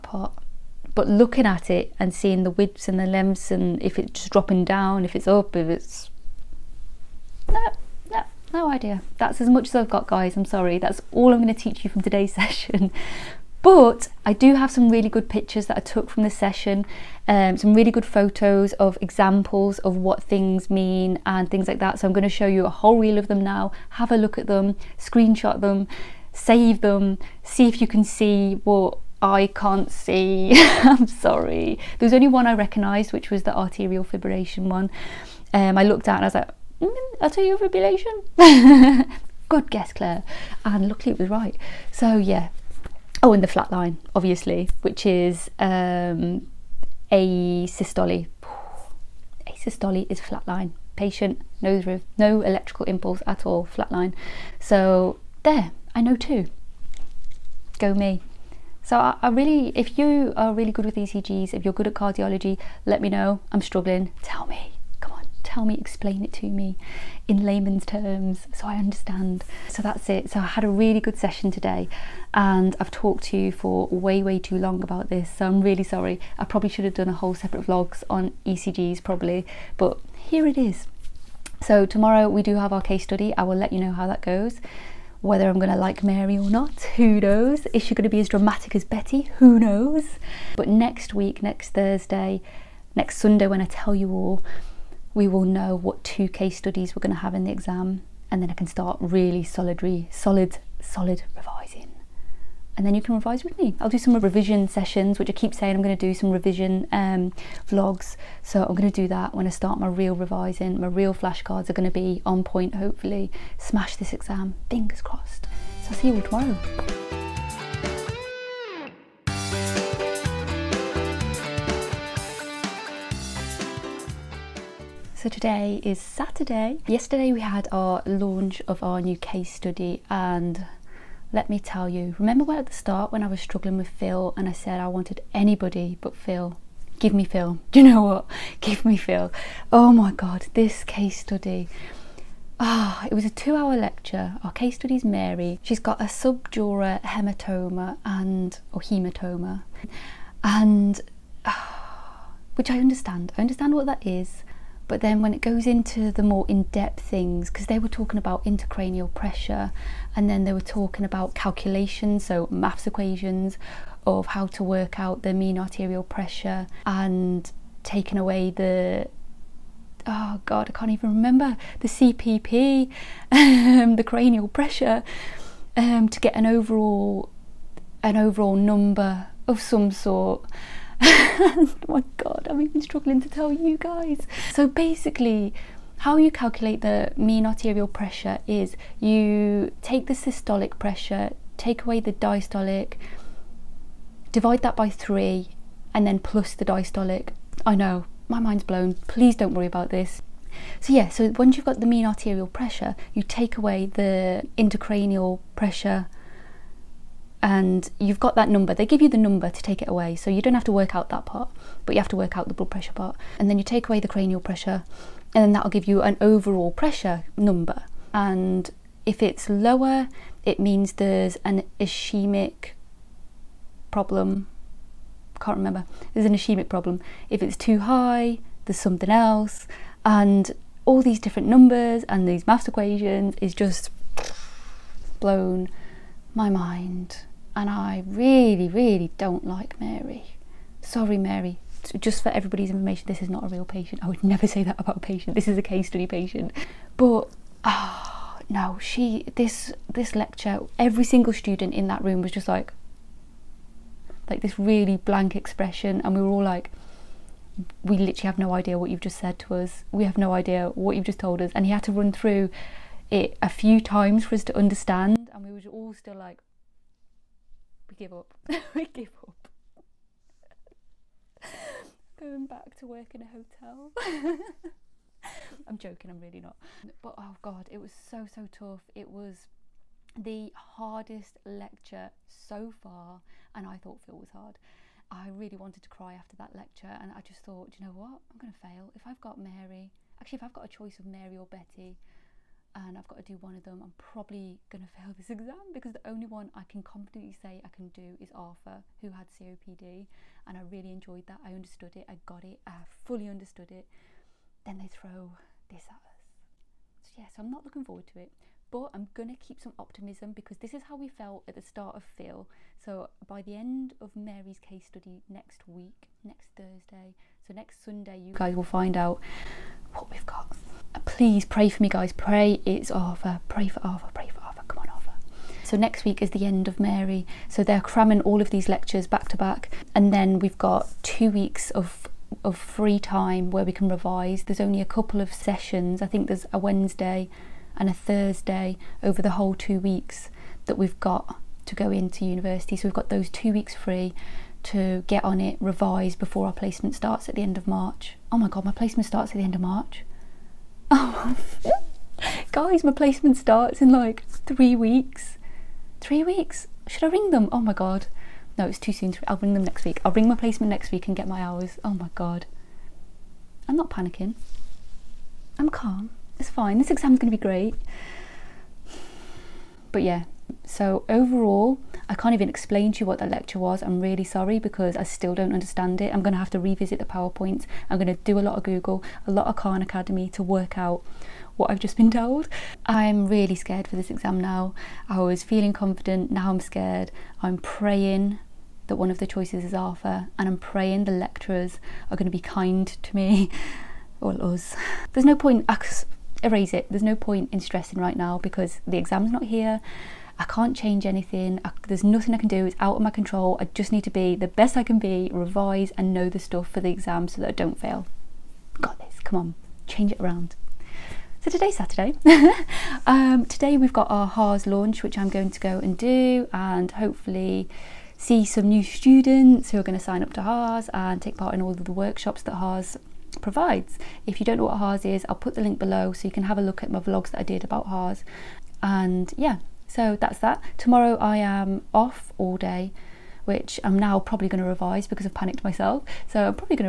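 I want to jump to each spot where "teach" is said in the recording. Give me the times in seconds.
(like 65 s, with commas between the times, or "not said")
11 s.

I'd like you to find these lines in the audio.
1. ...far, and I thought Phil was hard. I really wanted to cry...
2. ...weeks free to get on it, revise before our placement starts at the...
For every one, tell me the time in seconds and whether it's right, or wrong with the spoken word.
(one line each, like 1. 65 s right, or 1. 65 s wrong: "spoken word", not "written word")
1. 282 s right
2. 343 s right.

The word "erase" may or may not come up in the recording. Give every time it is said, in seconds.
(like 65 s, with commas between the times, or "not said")
396 s.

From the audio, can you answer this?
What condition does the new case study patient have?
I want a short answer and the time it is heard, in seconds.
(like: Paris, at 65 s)
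subdural hematoma, at 146 s.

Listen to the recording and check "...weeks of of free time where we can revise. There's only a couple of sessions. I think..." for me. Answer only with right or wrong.
right.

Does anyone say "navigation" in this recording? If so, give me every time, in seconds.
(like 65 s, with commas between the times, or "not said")
not said.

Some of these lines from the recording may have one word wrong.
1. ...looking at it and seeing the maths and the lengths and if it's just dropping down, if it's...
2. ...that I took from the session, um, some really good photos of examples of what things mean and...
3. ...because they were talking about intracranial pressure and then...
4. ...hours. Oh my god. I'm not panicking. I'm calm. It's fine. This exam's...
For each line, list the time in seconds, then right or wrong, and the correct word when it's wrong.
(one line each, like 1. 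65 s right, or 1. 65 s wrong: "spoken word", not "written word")
1. 1 s wrong: "widths", not "maths"
2. 15 s right
3. 157 s right
4. 361 s right.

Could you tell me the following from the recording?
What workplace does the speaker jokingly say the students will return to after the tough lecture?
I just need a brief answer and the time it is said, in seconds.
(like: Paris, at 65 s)
a hotel, at 273 s.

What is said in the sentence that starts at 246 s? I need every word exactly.
But, ah, oh, no, she, this, this lecture, every single student in that room was just like, like this really blank expression.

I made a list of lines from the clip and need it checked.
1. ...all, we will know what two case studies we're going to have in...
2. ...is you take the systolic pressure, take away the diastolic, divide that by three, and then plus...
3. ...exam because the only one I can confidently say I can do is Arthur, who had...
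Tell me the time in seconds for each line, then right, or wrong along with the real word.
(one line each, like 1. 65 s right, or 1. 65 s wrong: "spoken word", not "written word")
1. 94 s right
2. 188 s right
3. 295 s right.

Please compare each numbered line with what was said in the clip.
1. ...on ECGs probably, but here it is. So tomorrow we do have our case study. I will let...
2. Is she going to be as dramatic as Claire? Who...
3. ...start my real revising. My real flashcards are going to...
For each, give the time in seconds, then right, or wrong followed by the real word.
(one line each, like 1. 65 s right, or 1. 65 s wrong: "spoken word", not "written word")
1. 78 s right
2. 87 s wrong: "Betty", not "Claire"
3. 109 s right.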